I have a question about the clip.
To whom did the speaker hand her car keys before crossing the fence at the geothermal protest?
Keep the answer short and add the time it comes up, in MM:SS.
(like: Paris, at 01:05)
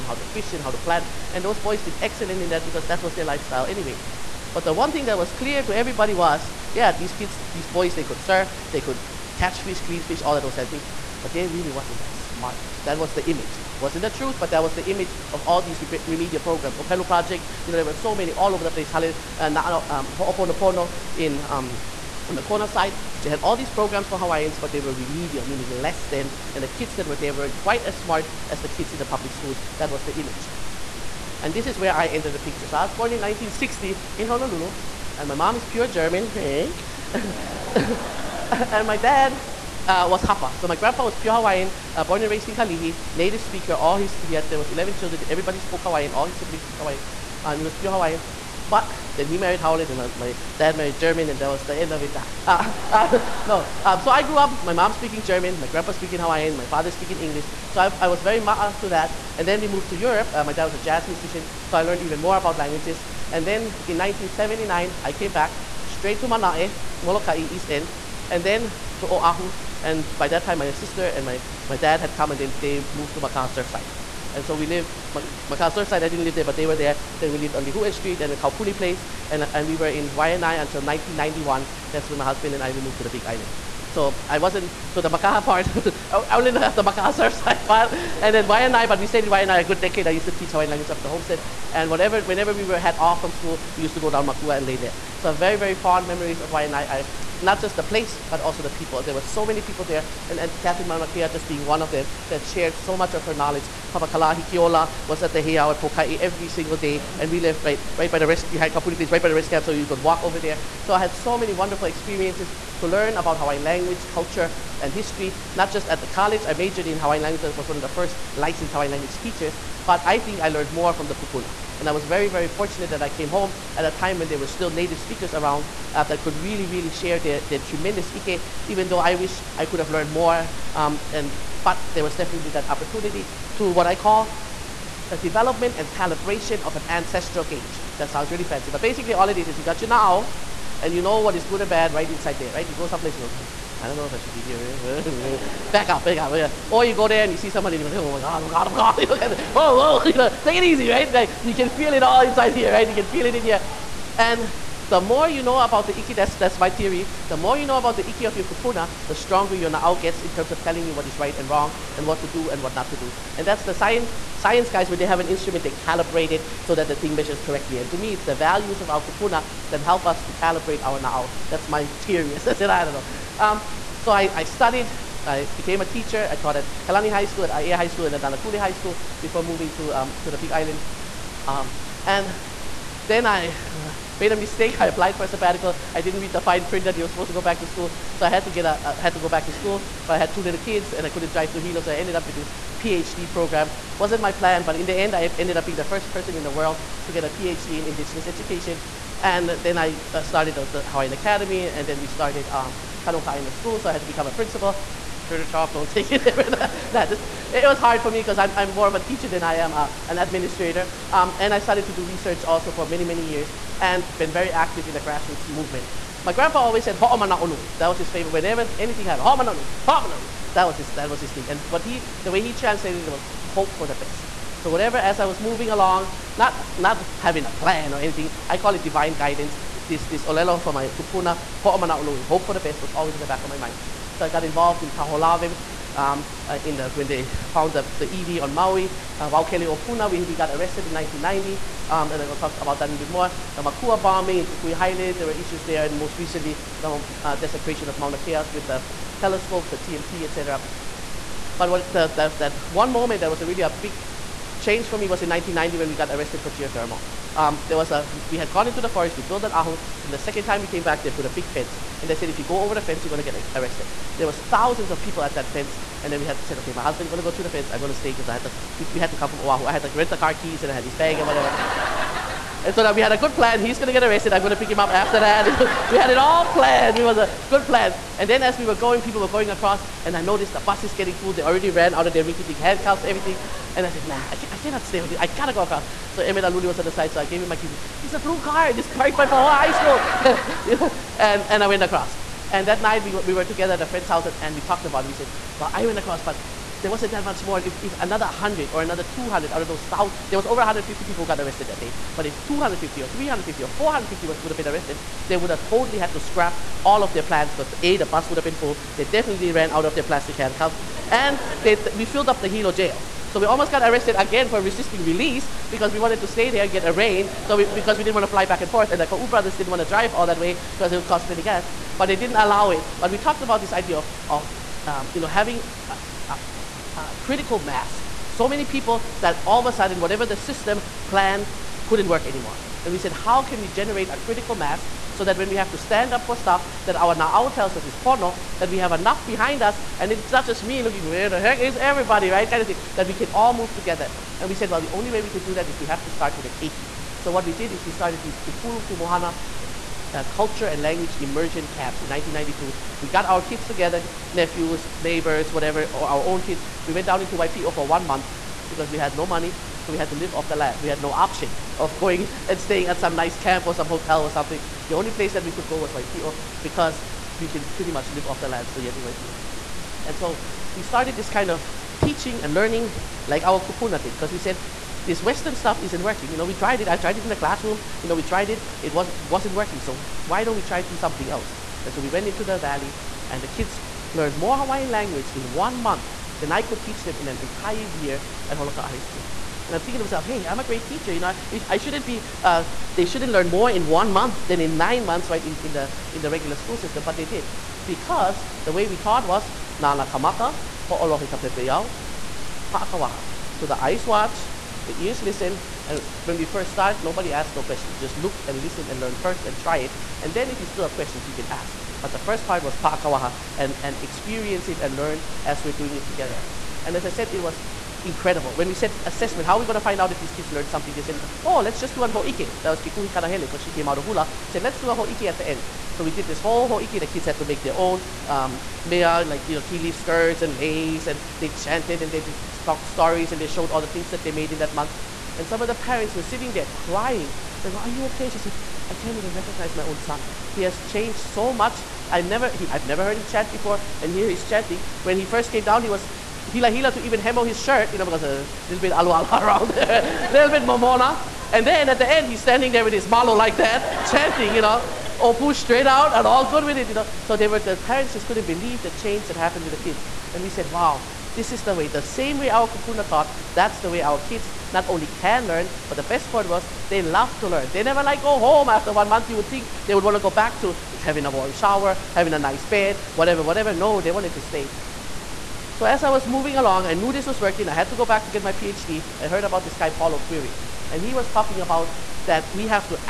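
Emmett Aluli, at 04:46.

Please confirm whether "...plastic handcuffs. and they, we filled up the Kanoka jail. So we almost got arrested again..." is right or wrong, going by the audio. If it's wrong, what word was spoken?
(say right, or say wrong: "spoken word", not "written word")
wrong: "Hilo", not "Kanoka".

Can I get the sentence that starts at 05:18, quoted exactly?
And the Kau brothers didn't want to drive all that way because it would cost plenty gas.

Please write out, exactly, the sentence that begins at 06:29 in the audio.
And I'm thinking to myself, hey, I'm a great teacher.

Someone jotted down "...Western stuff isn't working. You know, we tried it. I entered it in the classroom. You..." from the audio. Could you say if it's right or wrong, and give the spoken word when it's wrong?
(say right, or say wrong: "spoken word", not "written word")
wrong: "tried", not "entered".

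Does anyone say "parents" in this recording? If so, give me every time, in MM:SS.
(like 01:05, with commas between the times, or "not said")
07:15, 07:37.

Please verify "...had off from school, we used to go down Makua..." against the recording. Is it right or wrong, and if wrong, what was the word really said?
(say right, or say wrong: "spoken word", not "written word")
right.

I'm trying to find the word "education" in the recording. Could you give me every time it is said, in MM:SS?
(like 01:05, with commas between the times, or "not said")
03:18.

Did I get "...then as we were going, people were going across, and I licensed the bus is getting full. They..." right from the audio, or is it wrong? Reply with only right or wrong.
wrong.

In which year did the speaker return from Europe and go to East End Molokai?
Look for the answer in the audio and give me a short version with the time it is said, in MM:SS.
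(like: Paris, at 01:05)
1979, at 01:03.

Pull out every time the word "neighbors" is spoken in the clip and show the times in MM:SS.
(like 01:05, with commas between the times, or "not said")
05:54.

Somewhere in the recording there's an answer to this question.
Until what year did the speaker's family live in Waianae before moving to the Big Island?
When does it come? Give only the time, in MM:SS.
01:20.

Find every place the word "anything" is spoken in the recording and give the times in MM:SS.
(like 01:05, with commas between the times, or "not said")
03:38, 03:47.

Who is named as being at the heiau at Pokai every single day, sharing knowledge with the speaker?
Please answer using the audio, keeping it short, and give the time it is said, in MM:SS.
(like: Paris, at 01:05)
Papa Kalahi Kiola, at 01:43.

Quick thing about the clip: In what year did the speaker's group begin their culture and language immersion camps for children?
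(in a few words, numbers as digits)
1992.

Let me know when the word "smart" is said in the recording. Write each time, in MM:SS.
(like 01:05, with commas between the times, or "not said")
00:12, 00:27.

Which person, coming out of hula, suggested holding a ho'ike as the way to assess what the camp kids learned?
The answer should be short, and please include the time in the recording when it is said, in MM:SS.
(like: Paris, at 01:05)
Kekuhi Kanahele, at 07:02.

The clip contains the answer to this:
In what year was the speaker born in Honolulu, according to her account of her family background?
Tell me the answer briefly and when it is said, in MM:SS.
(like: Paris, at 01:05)
1960, at 00:33.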